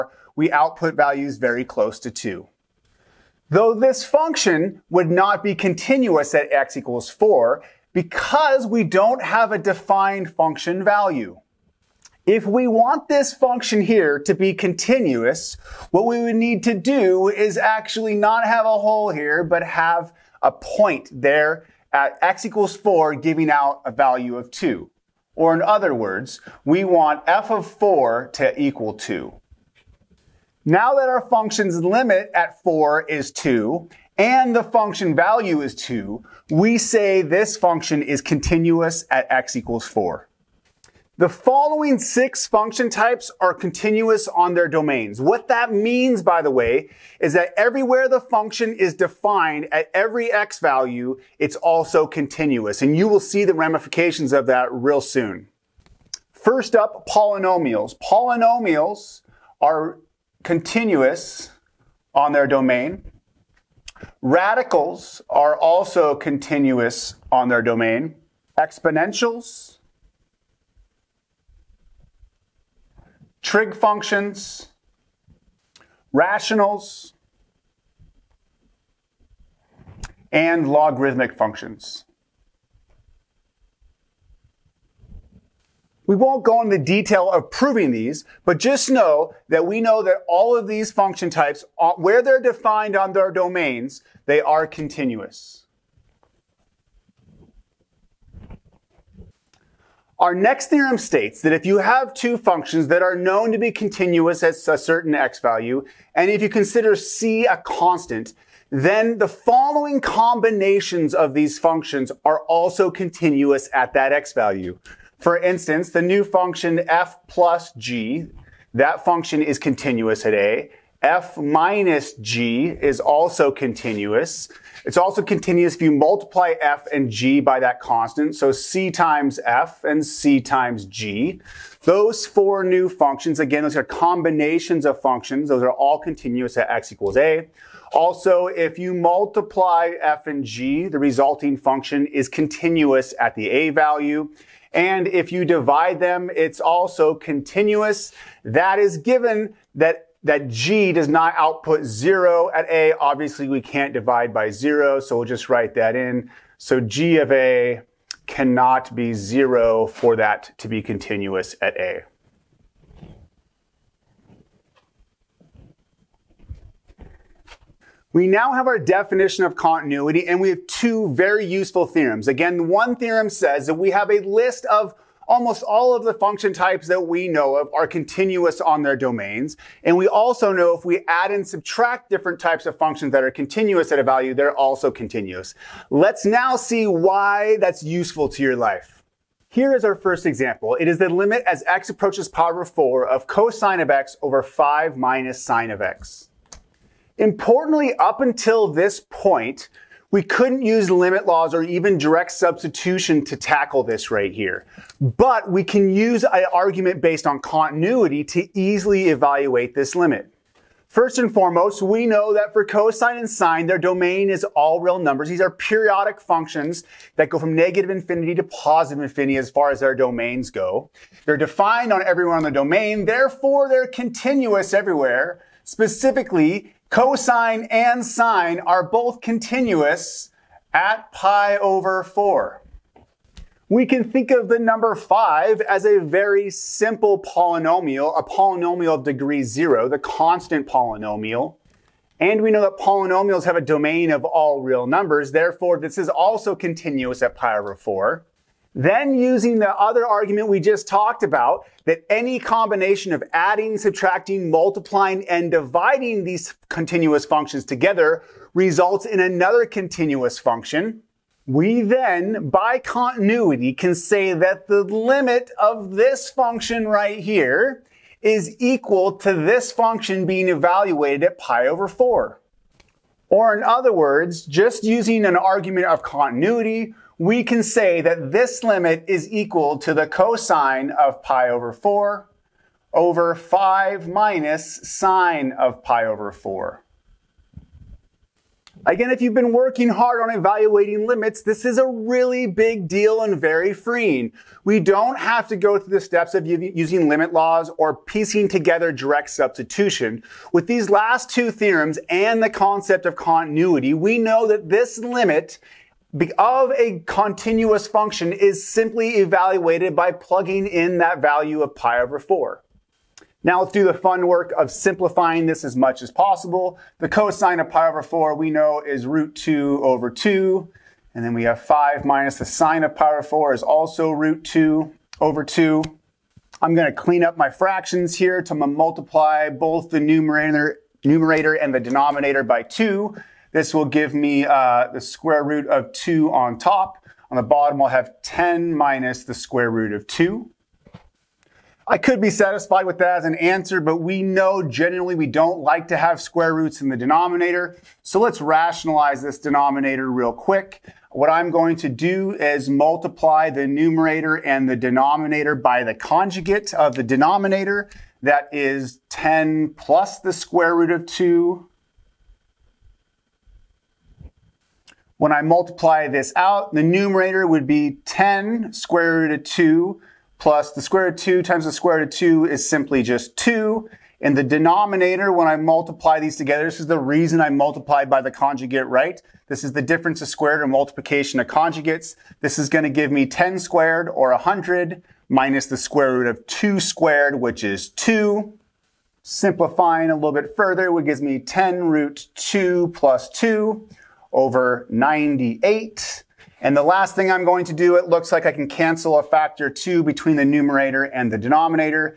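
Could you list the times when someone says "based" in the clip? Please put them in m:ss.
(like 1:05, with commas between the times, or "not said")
3:26.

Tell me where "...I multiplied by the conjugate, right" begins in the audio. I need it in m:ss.
6:17.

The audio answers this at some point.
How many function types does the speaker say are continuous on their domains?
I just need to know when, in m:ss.
0:41.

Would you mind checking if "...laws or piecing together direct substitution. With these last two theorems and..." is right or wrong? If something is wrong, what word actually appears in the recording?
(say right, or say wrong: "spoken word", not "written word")
right.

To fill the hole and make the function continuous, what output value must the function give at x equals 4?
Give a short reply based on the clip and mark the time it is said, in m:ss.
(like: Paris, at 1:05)
2, at 0:23.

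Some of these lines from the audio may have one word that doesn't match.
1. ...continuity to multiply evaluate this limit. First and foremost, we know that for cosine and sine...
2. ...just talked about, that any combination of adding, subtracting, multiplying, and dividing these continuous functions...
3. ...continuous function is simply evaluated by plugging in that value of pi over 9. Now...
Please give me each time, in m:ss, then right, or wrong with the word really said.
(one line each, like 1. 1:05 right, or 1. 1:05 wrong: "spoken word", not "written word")
1. 3:27 wrong: "easily", not "multiply"
2. 4:10 right
3. 5:07 wrong: "4", not "9".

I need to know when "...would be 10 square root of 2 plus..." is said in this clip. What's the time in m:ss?
6:07.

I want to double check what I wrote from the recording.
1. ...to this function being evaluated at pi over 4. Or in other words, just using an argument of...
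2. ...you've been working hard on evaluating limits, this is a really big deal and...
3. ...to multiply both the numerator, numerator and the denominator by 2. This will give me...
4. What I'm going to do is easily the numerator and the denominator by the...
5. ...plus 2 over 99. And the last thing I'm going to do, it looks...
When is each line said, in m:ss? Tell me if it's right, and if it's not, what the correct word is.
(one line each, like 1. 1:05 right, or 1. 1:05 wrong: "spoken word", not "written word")
1. 4:29 right
2. 4:49 right
3. 5:28 right
4. 5:51 wrong: "multiply", not "easily"
5. 6:32 wrong: "98", not "99".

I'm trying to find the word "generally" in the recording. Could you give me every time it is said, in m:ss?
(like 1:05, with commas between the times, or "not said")
5:44.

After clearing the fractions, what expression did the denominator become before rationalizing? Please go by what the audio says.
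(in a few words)
10 minus square root of 2.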